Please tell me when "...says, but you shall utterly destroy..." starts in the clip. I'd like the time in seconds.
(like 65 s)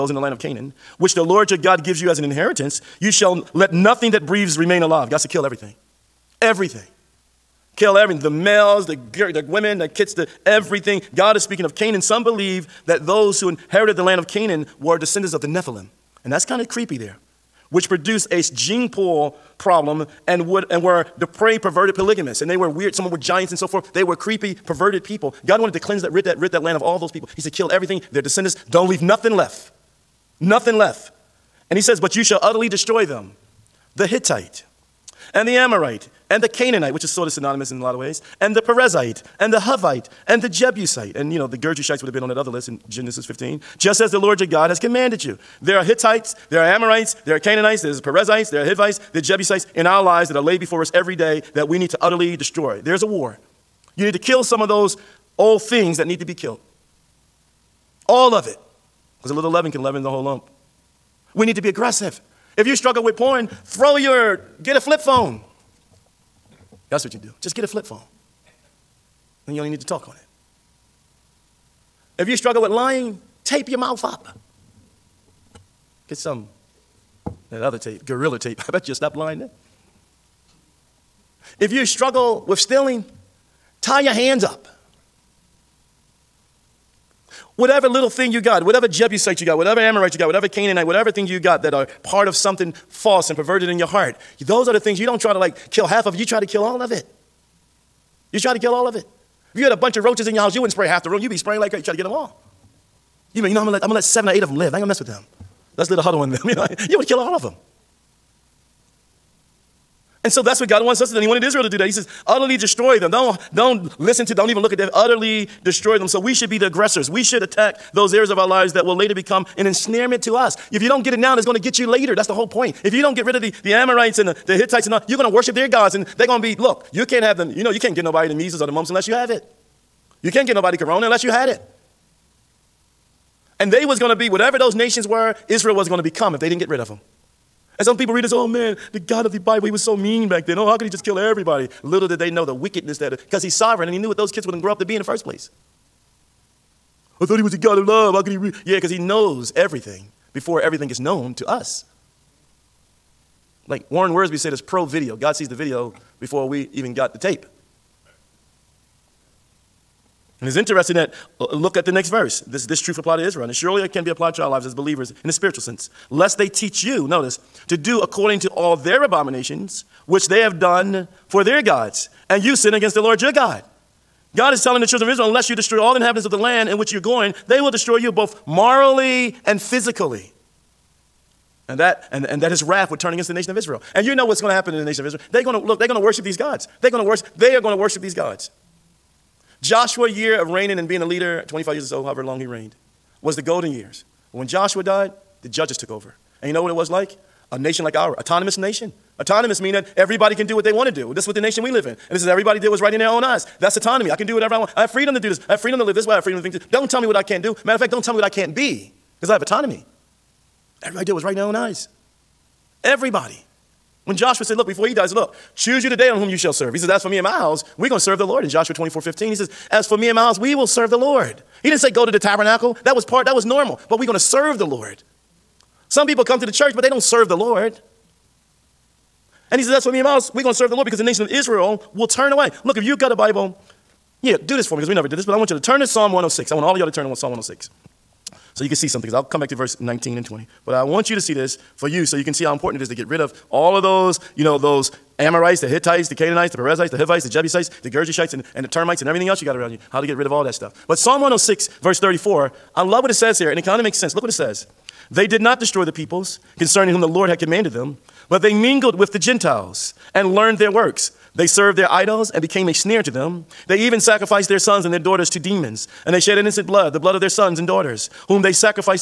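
31 s.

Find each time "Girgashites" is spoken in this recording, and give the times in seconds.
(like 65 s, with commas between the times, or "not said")
41 s, 247 s.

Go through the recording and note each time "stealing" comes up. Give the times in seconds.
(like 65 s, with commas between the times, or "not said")
82 s.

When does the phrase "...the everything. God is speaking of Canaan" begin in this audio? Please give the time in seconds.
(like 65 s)
10 s.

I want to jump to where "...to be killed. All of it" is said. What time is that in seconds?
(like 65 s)
56 s.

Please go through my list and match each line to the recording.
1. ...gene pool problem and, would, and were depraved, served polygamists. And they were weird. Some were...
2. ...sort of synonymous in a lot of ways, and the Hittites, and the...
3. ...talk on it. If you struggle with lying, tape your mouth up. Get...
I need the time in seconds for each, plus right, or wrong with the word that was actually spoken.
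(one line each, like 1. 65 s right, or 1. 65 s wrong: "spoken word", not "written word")
1. 18 s wrong: "perverted", not "served"
2. 37 s wrong: "Perizzite", not "Hittites"
3. 69 s right.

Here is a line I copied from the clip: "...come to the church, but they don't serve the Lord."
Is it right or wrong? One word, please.
right.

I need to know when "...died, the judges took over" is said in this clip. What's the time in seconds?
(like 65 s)
194 s.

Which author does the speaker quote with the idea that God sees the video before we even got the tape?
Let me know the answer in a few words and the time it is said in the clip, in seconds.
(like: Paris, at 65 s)
Warren Wiersbe, at 153 s.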